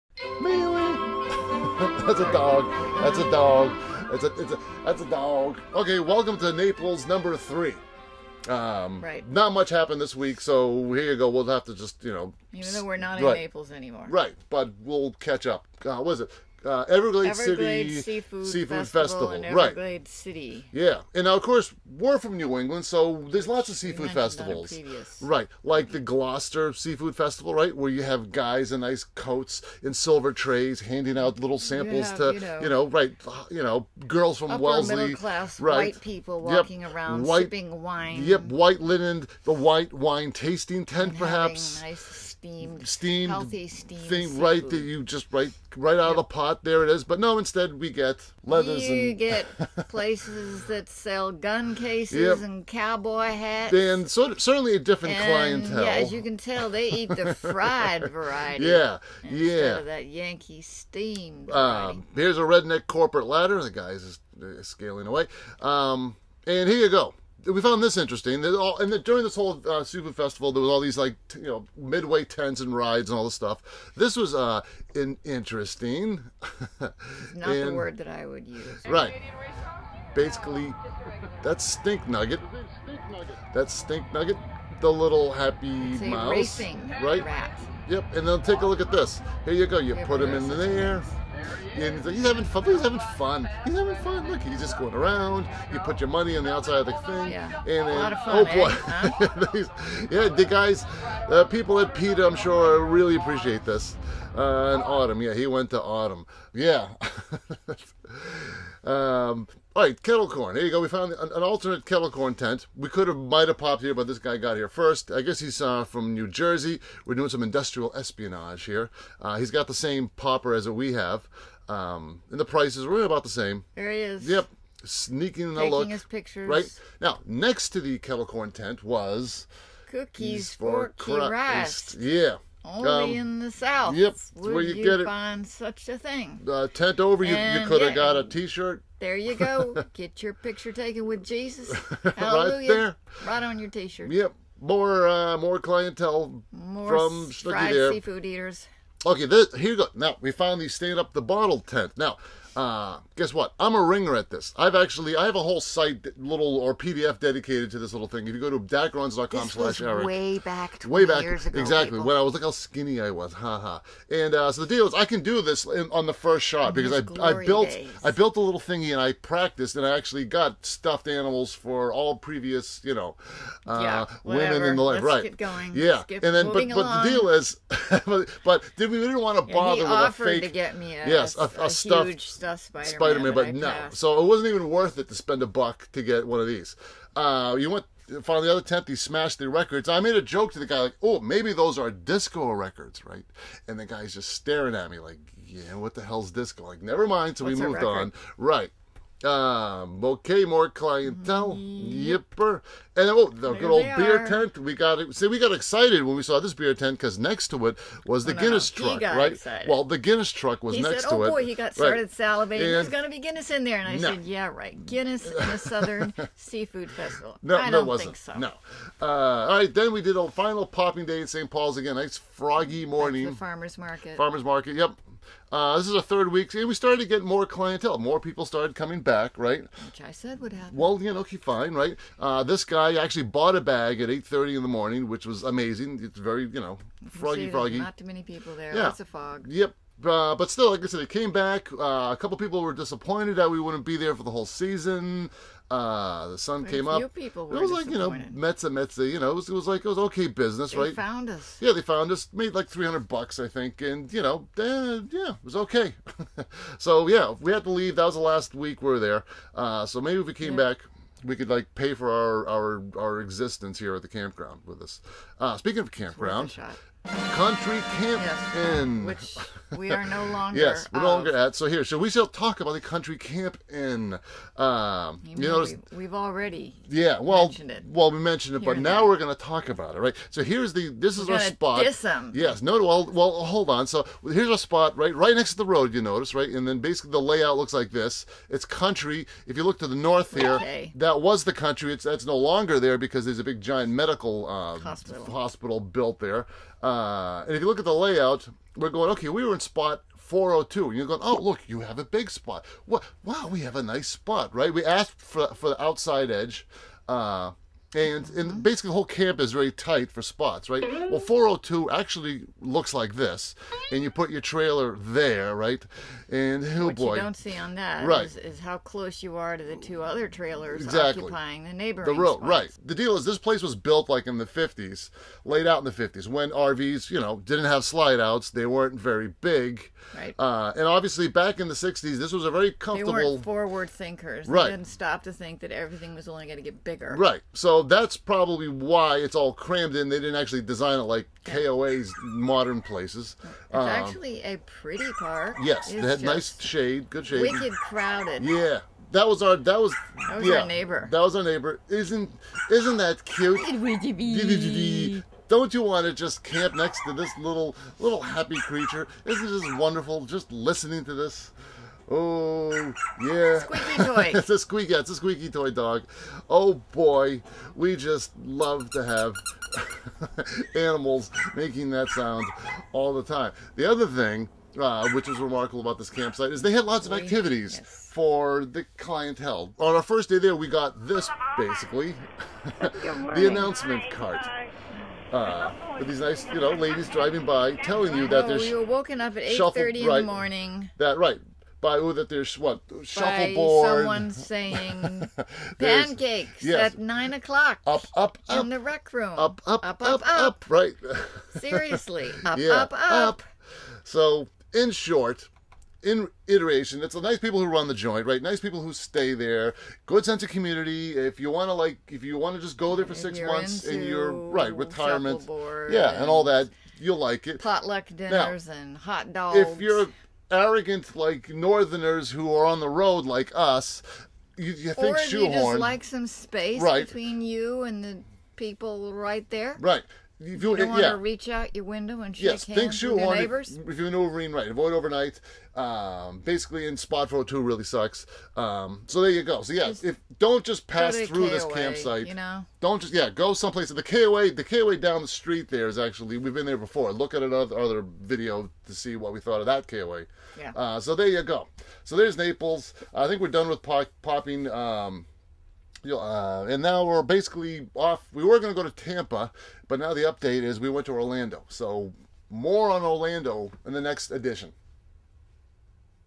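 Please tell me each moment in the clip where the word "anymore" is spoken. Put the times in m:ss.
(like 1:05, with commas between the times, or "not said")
0:13.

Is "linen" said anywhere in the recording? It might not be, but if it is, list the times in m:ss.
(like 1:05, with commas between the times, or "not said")
0:38.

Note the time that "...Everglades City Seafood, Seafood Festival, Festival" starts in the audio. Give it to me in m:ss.
0:17.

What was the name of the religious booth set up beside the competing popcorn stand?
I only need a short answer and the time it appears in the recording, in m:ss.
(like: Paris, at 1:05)
Cookies for Christ, at 2:09.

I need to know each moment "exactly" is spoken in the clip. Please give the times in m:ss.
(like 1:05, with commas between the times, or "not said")
2:41, 5:20.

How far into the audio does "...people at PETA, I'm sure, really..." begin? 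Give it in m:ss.
1:41.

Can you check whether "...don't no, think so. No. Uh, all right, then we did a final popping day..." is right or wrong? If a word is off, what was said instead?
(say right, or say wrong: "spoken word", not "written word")
right.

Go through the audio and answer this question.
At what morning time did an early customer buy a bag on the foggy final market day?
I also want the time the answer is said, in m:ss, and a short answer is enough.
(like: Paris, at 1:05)
8:30, at 3:54.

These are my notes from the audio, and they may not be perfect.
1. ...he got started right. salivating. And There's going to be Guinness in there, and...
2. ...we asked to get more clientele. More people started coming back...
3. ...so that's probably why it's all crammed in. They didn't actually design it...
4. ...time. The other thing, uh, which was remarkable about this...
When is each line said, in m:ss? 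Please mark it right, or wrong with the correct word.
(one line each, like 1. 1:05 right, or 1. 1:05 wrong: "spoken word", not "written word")
1. 3:31 right
2. 3:46 wrong: "started", not "asked"
3. 5:37 right
4. 6:13 right.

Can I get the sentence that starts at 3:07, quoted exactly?
Uh, you went finally the other tenth he smashed the records.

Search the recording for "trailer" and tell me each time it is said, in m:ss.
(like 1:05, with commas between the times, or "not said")
5:14, 5:20.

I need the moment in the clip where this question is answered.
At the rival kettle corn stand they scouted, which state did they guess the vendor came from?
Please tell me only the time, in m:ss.
1:56.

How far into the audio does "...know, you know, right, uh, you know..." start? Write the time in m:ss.
0:32.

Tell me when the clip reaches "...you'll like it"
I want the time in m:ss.
6:56.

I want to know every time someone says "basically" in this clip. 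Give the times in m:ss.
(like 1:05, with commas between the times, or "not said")
1:20, 4:46, 5:08, 6:21, 7:16, 7:37.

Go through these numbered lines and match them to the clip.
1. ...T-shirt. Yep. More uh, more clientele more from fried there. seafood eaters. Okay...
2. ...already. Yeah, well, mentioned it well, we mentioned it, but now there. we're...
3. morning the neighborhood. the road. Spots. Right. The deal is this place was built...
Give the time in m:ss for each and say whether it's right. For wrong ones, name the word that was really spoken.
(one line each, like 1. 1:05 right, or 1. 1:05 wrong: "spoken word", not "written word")
1. 2:23 right
2. 4:36 right
3. 5:21 wrong: "occupying", not "morning".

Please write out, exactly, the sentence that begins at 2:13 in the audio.
Yep, where you, you, get find such a thing.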